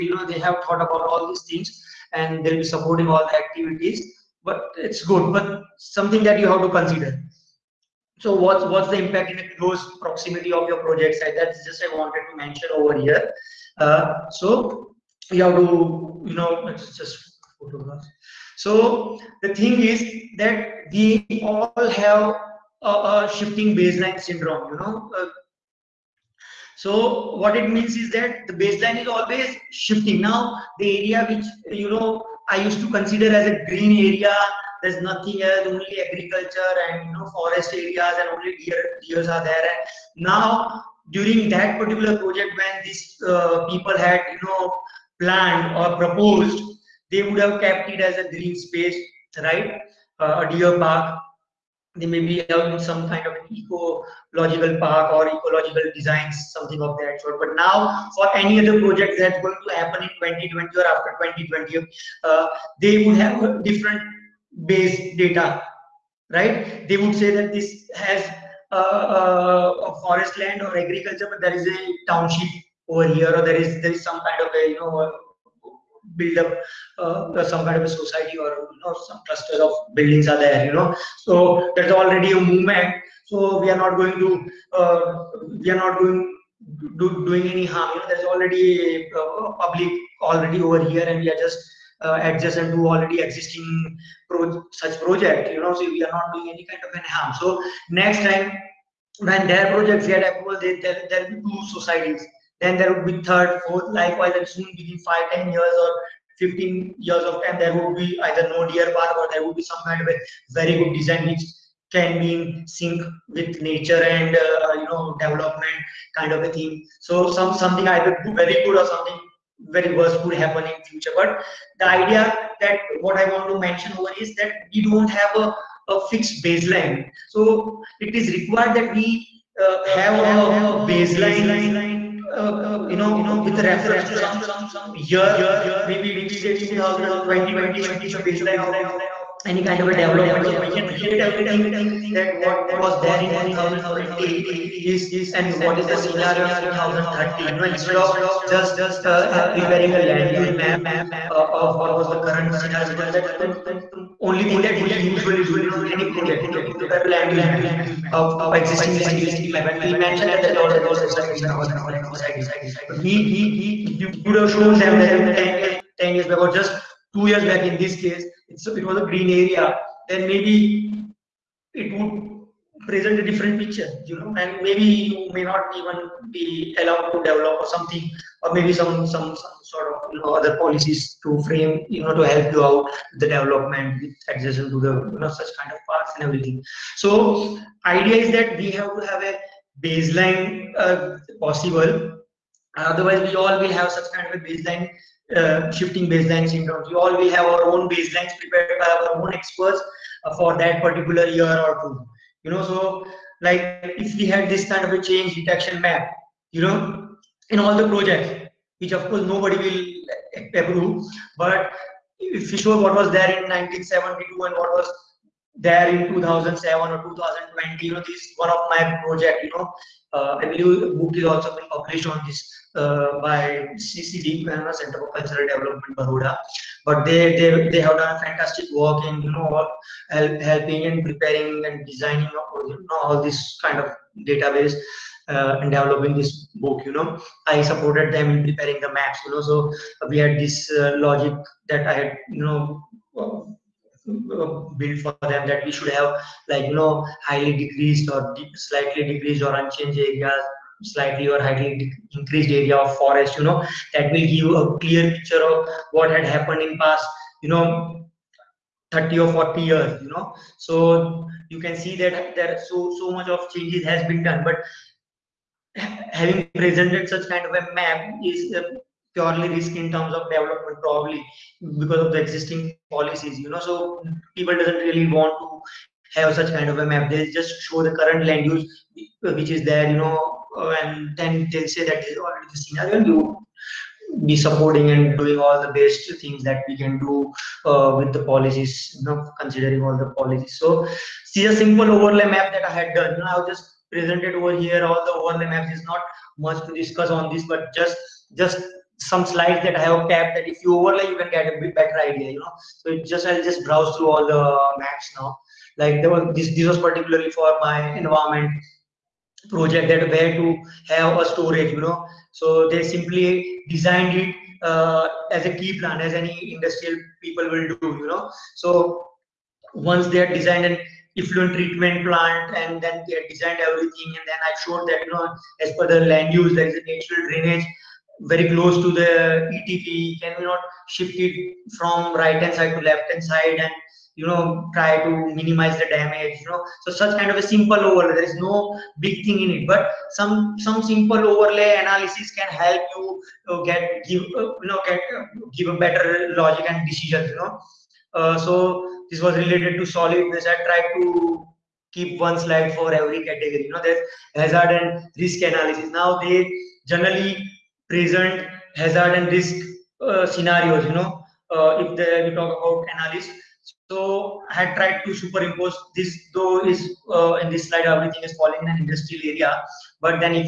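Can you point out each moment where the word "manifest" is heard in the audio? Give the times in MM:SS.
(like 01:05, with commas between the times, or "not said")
not said.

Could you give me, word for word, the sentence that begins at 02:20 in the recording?
So we can relate everything that what was there in 2020 is and what is the scenario in 2030.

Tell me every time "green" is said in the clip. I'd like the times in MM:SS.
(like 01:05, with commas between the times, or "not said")
00:33, 00:48, 02:49.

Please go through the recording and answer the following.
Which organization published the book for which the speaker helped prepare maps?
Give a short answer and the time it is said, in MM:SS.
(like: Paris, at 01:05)
Center for Cultural Development, at 03:43.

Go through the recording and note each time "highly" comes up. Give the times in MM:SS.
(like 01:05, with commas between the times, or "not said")
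04:07, 04:11.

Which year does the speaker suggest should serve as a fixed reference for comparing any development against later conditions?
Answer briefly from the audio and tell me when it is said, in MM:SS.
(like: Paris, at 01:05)
2020, at 02:16.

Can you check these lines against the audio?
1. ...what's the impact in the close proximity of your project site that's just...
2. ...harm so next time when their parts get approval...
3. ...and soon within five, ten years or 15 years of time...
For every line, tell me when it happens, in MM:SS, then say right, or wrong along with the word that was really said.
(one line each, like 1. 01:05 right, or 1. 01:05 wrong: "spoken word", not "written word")
1. 00:08 right
2. 01:37 wrong: "projects", not "parts"
3. 01:44 right.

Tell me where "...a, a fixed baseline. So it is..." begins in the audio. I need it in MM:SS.
02:05.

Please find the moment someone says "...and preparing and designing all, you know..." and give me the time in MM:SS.
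03:50.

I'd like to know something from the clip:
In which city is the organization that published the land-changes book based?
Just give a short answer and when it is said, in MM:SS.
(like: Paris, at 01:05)
Baroda, at 03:45.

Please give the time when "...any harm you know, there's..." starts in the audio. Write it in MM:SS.
01:27.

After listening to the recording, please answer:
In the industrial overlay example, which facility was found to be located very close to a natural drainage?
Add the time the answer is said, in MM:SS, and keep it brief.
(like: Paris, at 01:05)
effluent treatment plant, at 05:21.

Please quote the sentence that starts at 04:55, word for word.
is not much to discuss on this, but just just some slides that I have kept.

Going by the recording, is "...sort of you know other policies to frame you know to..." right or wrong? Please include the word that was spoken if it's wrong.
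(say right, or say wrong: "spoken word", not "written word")
right.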